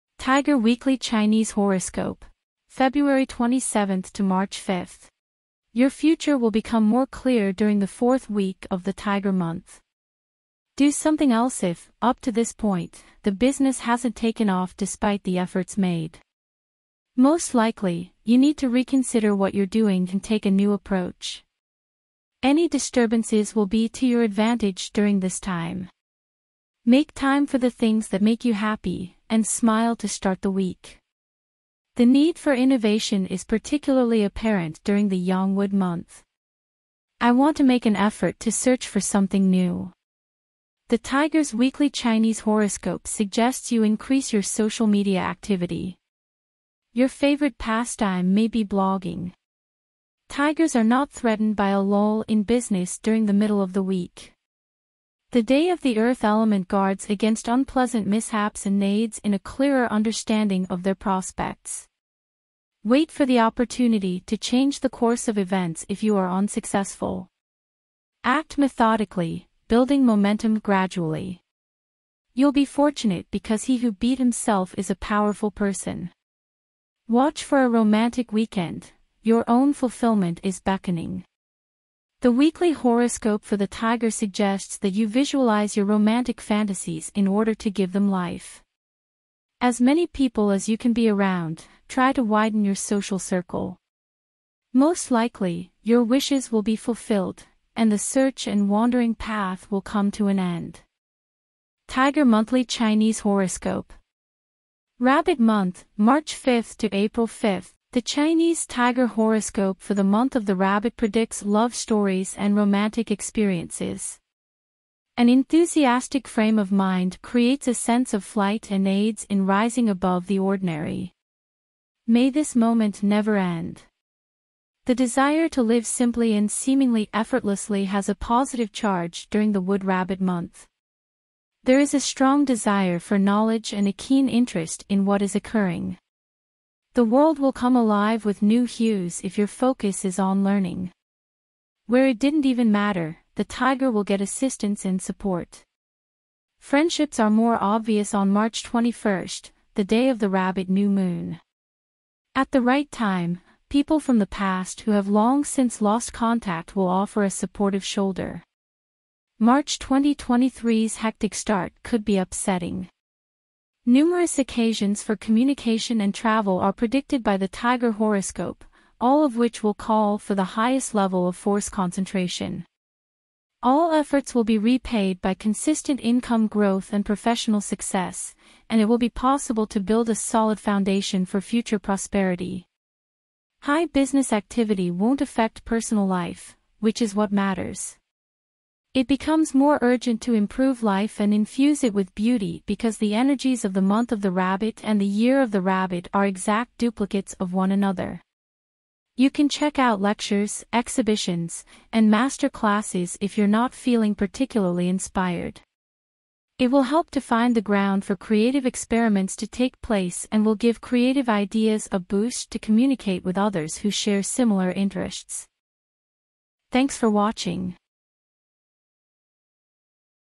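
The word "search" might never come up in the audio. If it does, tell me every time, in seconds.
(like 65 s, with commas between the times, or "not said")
38 s, 97 s.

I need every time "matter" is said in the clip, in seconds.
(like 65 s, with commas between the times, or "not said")
142 s, 187 s.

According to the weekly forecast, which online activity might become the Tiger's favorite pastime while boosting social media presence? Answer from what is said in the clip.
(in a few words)
Blogging.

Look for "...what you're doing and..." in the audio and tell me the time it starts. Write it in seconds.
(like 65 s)
19 s.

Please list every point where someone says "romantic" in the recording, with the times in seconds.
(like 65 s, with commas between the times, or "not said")
77 s, 85 s, 112 s.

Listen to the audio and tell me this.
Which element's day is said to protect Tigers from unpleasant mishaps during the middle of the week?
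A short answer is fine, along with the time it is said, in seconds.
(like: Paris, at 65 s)
Earth, at 55 s.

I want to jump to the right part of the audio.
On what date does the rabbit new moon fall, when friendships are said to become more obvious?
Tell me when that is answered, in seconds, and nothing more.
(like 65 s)
148 s.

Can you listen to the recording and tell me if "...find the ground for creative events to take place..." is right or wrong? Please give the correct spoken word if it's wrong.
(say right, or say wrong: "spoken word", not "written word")
wrong: "experiments", not "events".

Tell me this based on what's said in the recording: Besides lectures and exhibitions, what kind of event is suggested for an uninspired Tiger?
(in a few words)
Master classes.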